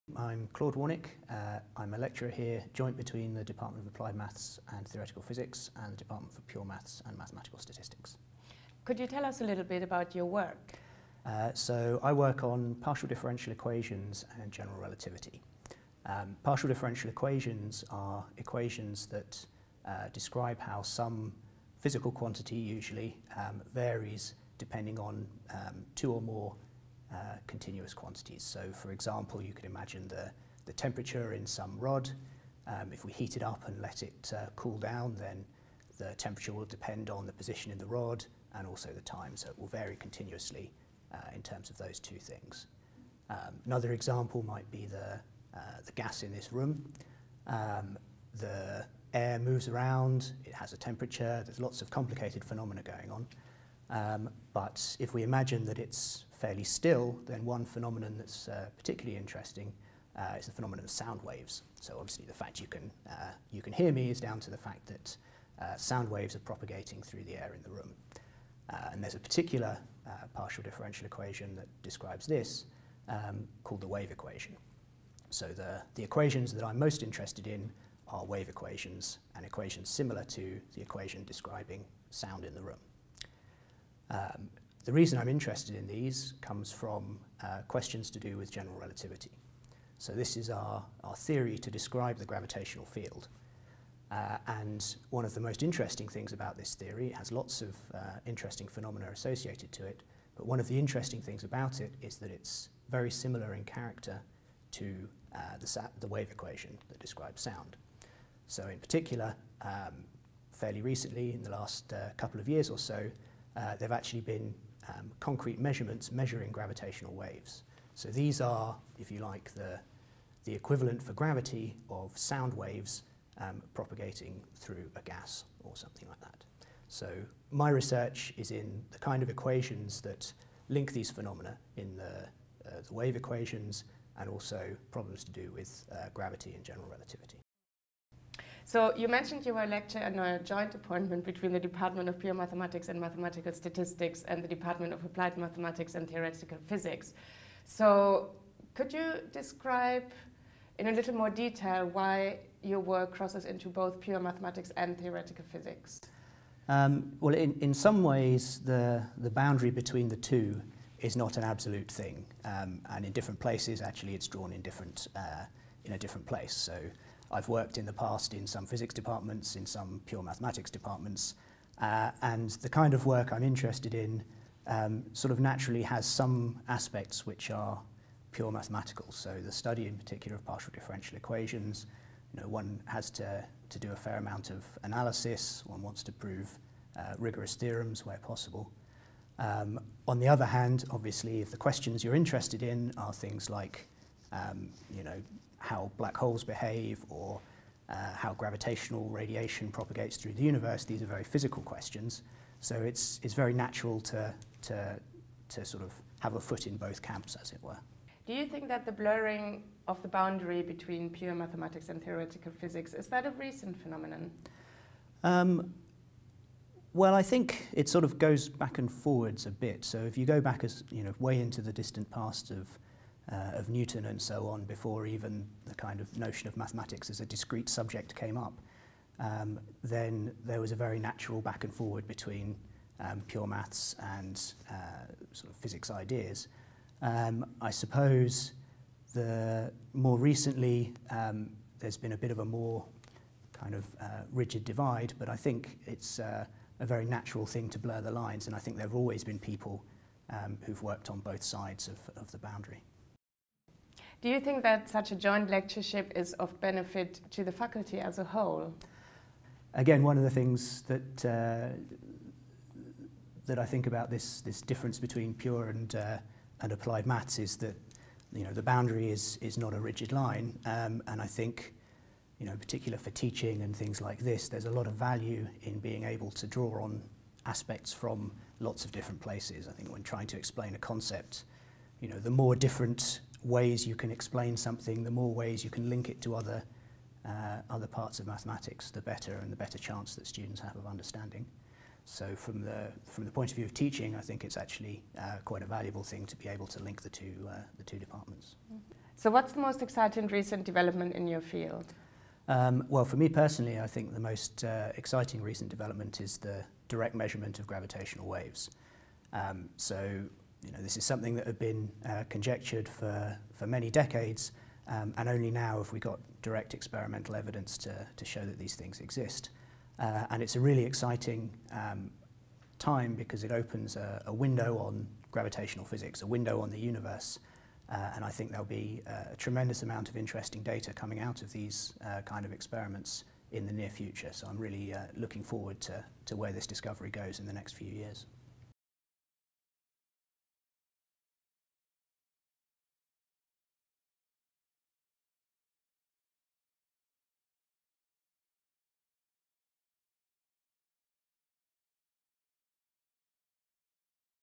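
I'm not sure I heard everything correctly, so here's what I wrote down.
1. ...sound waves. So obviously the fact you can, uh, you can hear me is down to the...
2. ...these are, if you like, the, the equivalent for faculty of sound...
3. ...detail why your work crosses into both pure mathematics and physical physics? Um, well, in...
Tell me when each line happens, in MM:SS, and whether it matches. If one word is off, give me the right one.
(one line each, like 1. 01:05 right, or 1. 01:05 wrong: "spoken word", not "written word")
1. 01:00 right
2. 01:58 wrong: "gravity", not "faculty"
3. 02:31 wrong: "theoretical", not "physical".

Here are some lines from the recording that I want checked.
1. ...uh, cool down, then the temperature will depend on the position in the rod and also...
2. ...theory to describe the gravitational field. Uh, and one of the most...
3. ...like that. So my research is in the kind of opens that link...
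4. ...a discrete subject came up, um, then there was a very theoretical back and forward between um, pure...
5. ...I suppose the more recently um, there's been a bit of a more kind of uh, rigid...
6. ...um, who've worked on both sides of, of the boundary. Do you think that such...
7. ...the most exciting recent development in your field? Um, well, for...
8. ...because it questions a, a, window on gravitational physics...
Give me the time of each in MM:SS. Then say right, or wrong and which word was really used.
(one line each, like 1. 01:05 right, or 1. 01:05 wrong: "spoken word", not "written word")
1. 00:34 right
2. 01:31 right
3. 02:06 wrong: "equations", not "opens"
4. 03:47 wrong: "natural", not "theoretical"
5. 03:57 right
6. 04:10 right
7. 04:59 right
8. 05:23 wrong: "opens", not "questions".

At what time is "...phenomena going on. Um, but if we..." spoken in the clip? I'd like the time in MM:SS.
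00:52.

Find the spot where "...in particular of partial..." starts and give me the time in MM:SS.
02:59.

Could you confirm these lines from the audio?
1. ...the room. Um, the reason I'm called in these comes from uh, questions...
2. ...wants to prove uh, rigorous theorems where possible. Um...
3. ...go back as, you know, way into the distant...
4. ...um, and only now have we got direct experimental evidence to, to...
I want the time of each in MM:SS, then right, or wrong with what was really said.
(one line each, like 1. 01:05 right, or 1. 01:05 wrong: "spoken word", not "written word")
1. 01:22 wrong: "interested", not "called"
2. 03:05 right
3. 03:40 right
4. 05:14 right.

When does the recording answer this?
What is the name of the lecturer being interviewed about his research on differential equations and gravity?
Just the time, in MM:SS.
00:00.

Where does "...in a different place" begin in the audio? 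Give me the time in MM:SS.
02:45.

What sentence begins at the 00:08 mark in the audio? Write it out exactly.
Could you tell us a little bit about your work?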